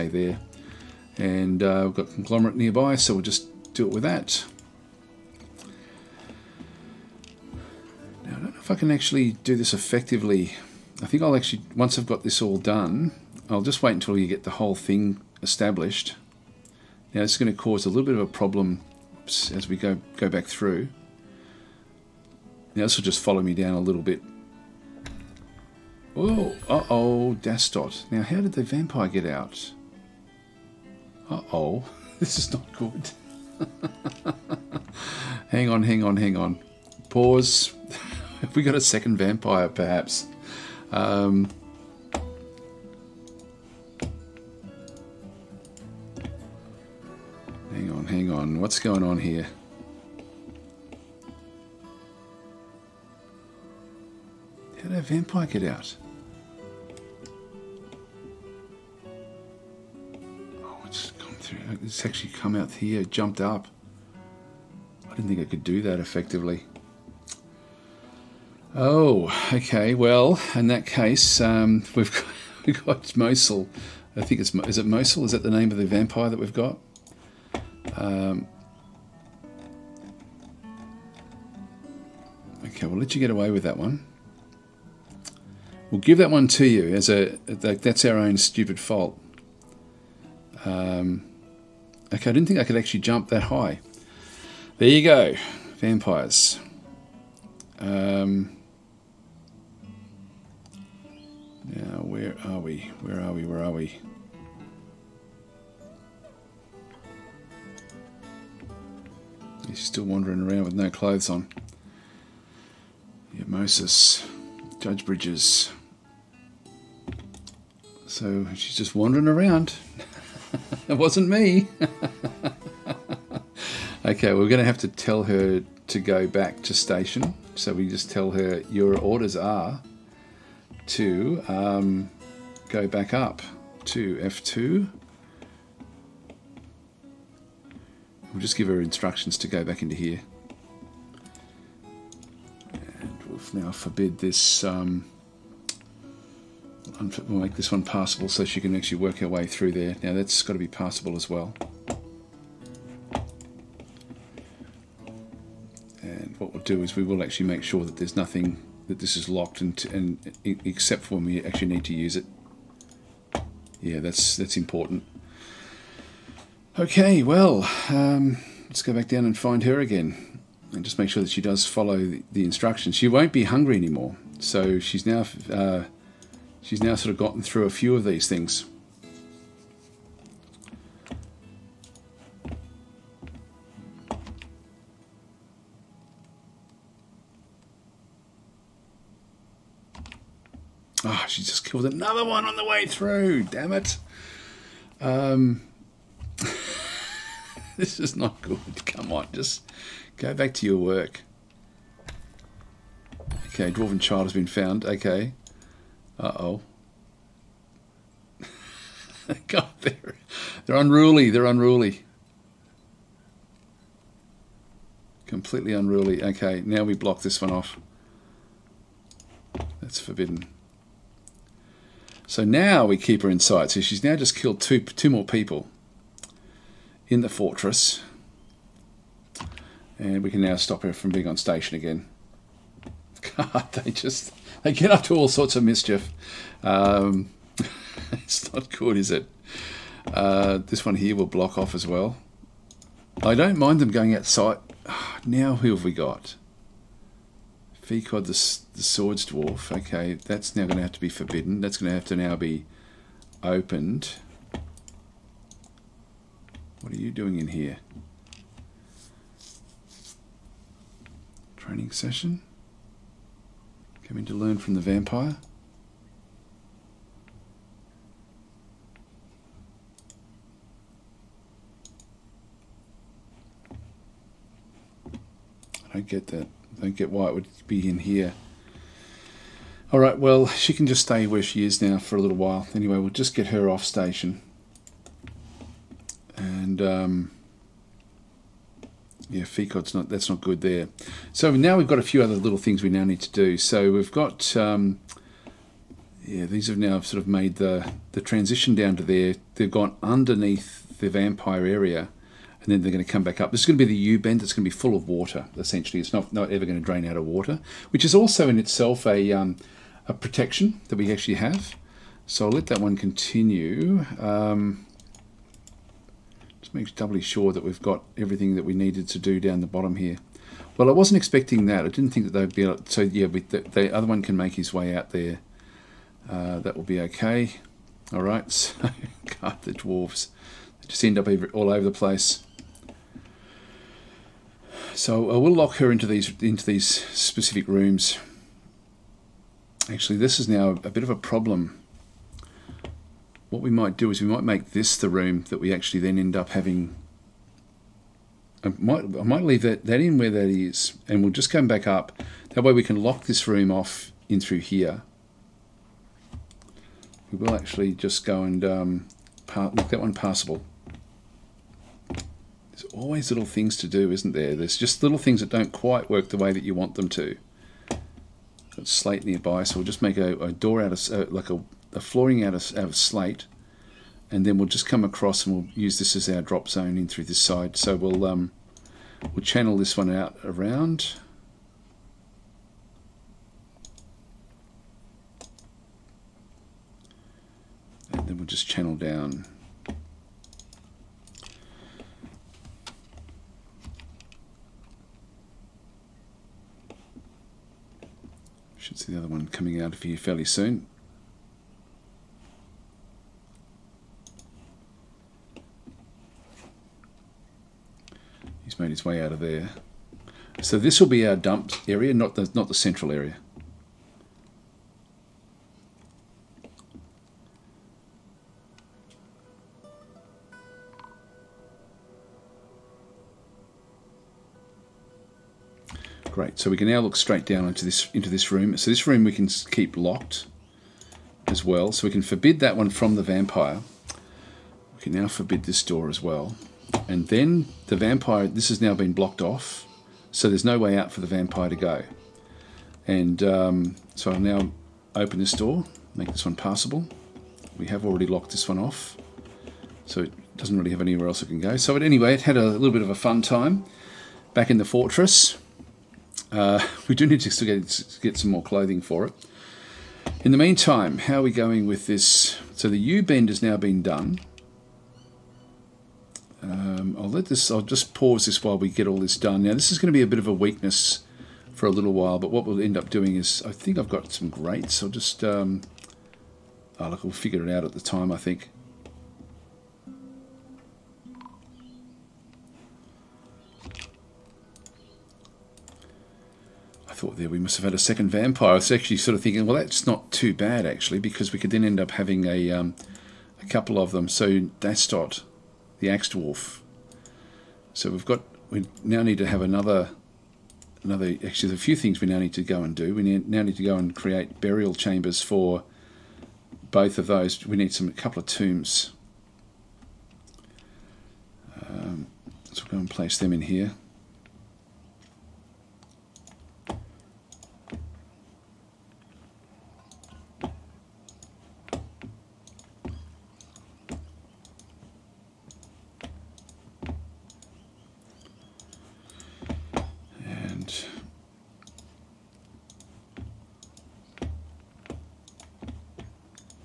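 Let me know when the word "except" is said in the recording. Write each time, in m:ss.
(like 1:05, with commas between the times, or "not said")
2:40.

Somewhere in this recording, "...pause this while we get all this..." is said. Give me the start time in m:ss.
7:48.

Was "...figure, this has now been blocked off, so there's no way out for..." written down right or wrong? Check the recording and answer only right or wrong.
wrong.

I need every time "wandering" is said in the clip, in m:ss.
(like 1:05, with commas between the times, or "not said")
1:50, 1:58.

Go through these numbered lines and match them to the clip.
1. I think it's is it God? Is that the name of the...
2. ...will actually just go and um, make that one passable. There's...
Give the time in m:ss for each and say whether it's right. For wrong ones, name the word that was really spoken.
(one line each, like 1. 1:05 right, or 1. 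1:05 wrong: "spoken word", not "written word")
1. 1:14 wrong: "Mosul", not "God"
2. 5:57 right.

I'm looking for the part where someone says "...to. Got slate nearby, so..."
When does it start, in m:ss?
6:07.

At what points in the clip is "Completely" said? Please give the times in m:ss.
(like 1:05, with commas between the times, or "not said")
3:35.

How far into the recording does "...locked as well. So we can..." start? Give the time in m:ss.
7:09.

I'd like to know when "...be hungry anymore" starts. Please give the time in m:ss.
2:53.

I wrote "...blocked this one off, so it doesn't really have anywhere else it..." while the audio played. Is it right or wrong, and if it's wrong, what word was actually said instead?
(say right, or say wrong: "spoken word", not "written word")
wrong: "locked", not "blocked".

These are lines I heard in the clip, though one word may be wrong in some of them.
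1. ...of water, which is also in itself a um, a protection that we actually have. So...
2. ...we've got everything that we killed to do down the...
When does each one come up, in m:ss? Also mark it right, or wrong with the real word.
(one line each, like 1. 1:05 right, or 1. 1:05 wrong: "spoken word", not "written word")
1. 5:07 right
2. 5:17 wrong: "needed", not "killed".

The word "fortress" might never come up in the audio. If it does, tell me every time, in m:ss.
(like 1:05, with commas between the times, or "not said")
3:47, 7:34.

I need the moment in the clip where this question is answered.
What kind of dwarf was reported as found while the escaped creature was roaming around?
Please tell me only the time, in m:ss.
3:23.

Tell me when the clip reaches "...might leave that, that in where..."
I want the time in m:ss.
5:49.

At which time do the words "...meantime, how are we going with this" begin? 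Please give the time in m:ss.
7:40.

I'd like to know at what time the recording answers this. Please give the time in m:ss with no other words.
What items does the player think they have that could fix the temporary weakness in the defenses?
7:54.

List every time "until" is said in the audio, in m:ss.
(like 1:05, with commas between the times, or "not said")
0:13.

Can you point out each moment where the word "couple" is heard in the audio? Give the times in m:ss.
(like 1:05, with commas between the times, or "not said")
8:13, 8:28.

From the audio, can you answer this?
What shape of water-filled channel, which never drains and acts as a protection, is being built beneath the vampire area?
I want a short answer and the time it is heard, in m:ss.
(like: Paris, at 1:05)
U bend, at 5:03.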